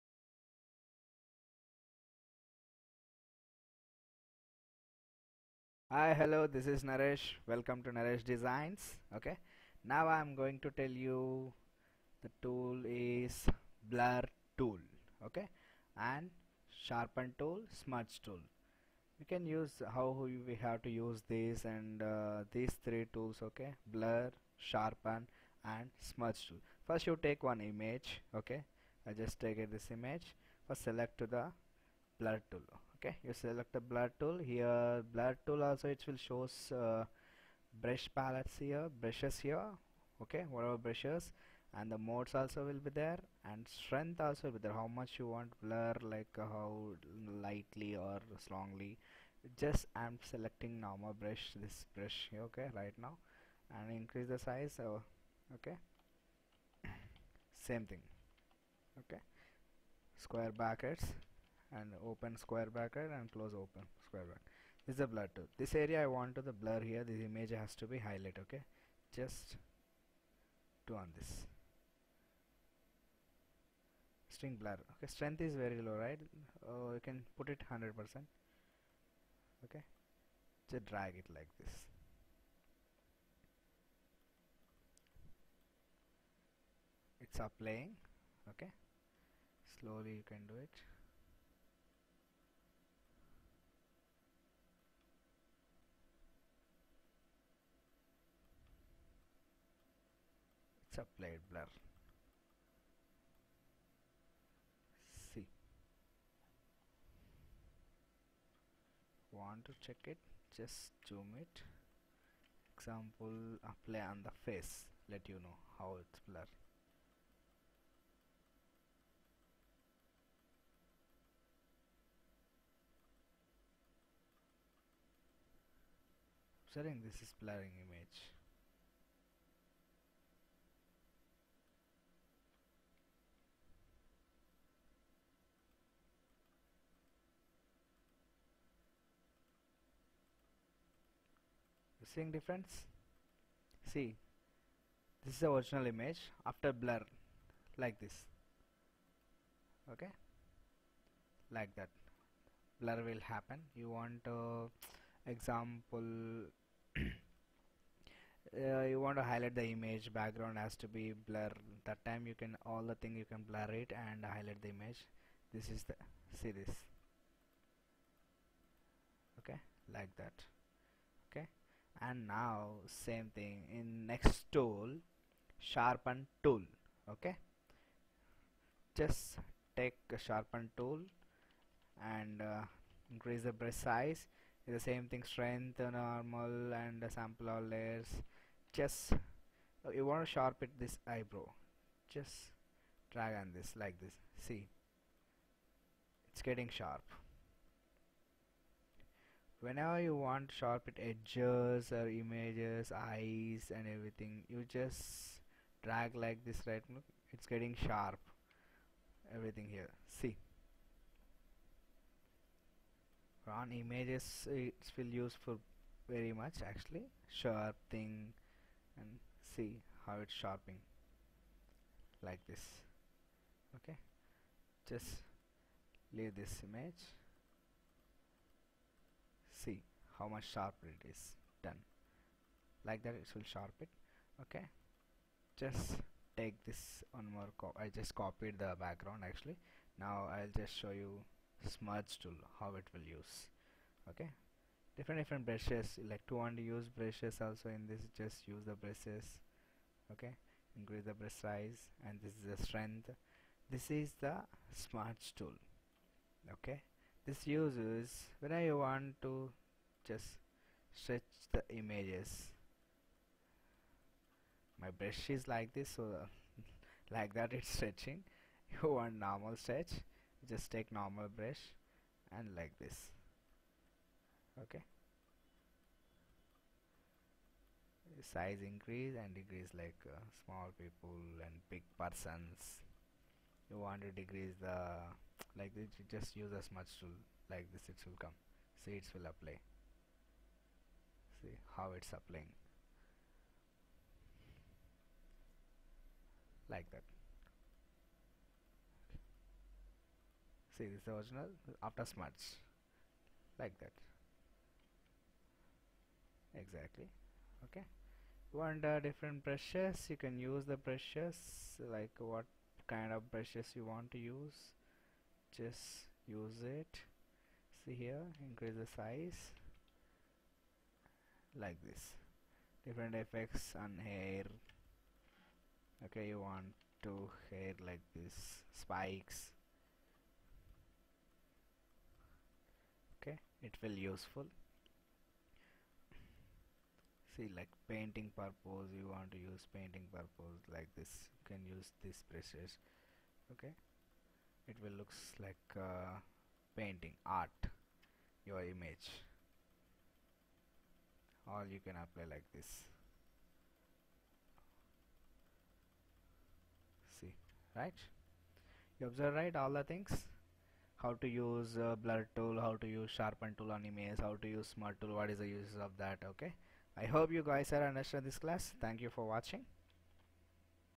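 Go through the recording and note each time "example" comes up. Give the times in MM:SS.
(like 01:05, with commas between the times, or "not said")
01:52, 02:35.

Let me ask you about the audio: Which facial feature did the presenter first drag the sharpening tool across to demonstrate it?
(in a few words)
eyebrow.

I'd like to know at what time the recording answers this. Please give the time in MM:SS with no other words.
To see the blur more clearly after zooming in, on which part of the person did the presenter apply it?
01:54.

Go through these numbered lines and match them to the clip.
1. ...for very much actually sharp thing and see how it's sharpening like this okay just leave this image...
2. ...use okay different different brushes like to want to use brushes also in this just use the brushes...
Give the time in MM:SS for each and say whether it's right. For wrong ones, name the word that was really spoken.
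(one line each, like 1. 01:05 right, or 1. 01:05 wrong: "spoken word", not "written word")
1. 03:35 right
2. 04:03 right.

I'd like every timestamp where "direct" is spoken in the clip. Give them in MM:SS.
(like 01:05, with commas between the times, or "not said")
not said.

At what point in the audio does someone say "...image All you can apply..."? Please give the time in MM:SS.
05:48.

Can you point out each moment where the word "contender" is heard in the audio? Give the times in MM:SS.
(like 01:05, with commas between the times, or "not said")
not said.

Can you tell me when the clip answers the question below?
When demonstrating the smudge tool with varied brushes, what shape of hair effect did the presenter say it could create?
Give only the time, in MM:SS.
05:28.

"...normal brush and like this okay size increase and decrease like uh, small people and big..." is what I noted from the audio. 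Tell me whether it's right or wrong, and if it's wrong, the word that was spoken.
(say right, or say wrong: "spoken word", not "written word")
right.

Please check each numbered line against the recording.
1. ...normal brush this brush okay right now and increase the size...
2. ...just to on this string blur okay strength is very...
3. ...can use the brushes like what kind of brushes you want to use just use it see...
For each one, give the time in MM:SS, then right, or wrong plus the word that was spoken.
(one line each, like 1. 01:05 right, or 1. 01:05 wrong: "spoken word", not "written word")
1. 00:50 right
2. 01:09 right
3. 05:10 right.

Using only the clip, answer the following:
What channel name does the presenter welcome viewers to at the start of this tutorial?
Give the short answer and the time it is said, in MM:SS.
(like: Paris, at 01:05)
Naresh Designs, at 00:07.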